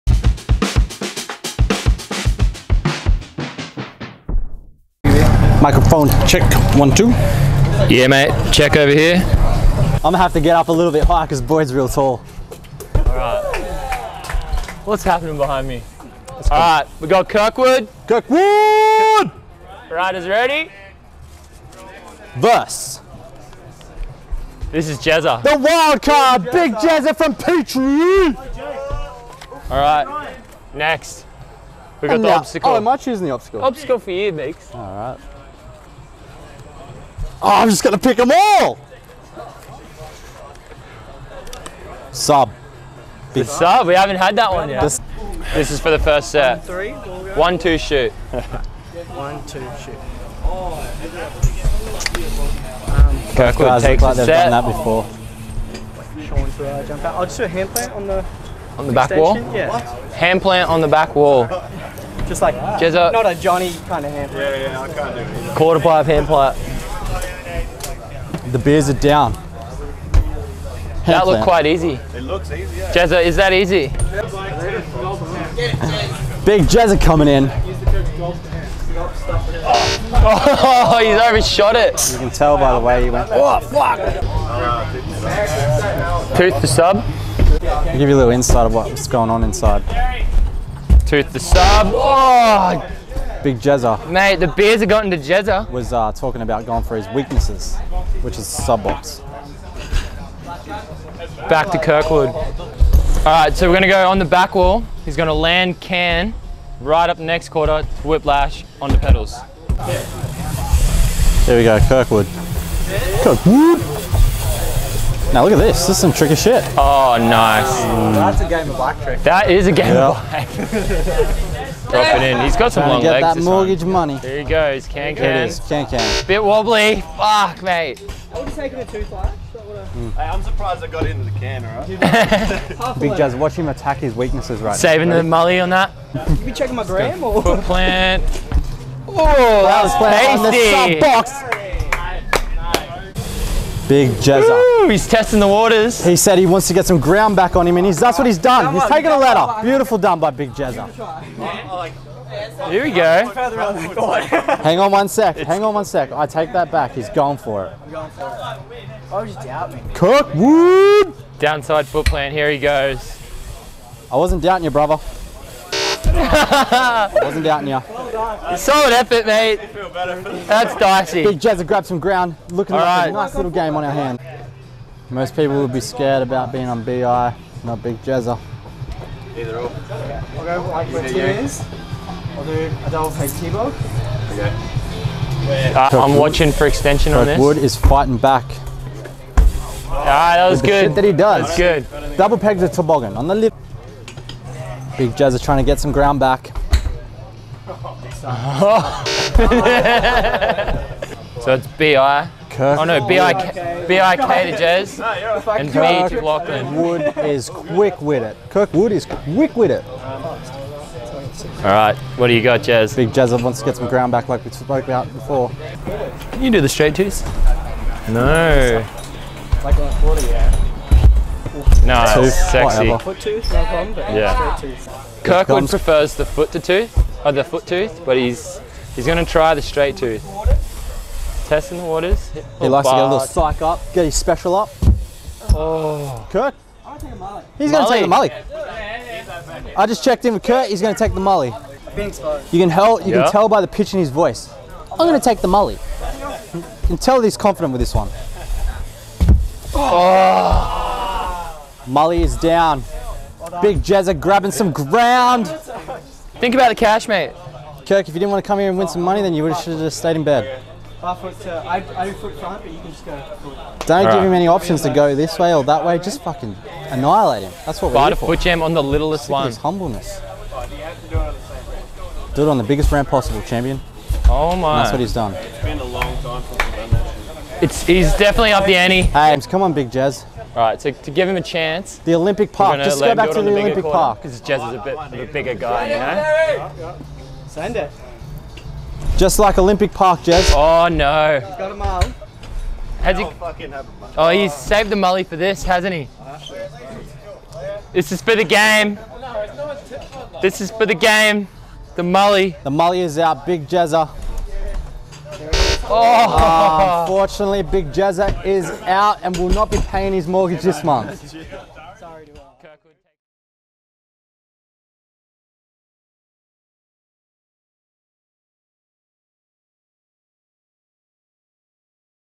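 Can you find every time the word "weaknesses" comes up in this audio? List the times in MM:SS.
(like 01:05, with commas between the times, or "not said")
01:37, 02:14.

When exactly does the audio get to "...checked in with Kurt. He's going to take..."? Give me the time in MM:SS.
04:00.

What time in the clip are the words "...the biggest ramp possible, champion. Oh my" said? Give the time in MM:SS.
04:32.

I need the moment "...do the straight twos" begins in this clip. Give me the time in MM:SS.
03:36.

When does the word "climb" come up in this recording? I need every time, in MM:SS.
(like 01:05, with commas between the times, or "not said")
not said.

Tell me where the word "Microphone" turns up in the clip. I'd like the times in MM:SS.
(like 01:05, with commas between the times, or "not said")
00:05.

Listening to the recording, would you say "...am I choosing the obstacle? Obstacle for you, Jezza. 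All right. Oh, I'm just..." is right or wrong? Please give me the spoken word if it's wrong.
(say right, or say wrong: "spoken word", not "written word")
wrong: "Meeks", not "Jezza".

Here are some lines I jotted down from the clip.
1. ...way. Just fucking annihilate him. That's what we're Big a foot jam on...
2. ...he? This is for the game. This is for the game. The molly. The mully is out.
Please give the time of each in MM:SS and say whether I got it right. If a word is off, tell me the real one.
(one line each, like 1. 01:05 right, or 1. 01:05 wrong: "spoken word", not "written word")
1. 04:25 wrong: "Fight", not "Big"
2. 04:55 wrong: "molly", not "mully".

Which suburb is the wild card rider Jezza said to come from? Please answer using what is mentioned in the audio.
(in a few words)
Petrie.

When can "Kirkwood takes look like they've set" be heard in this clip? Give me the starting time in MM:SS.
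00:53.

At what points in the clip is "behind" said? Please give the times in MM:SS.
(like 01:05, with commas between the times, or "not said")
00:15.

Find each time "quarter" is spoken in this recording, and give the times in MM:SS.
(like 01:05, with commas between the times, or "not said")
01:05, 01:47.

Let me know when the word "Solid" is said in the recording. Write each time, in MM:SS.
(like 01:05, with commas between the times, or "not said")
02:48.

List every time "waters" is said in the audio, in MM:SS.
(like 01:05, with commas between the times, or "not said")
02:25, 03:51.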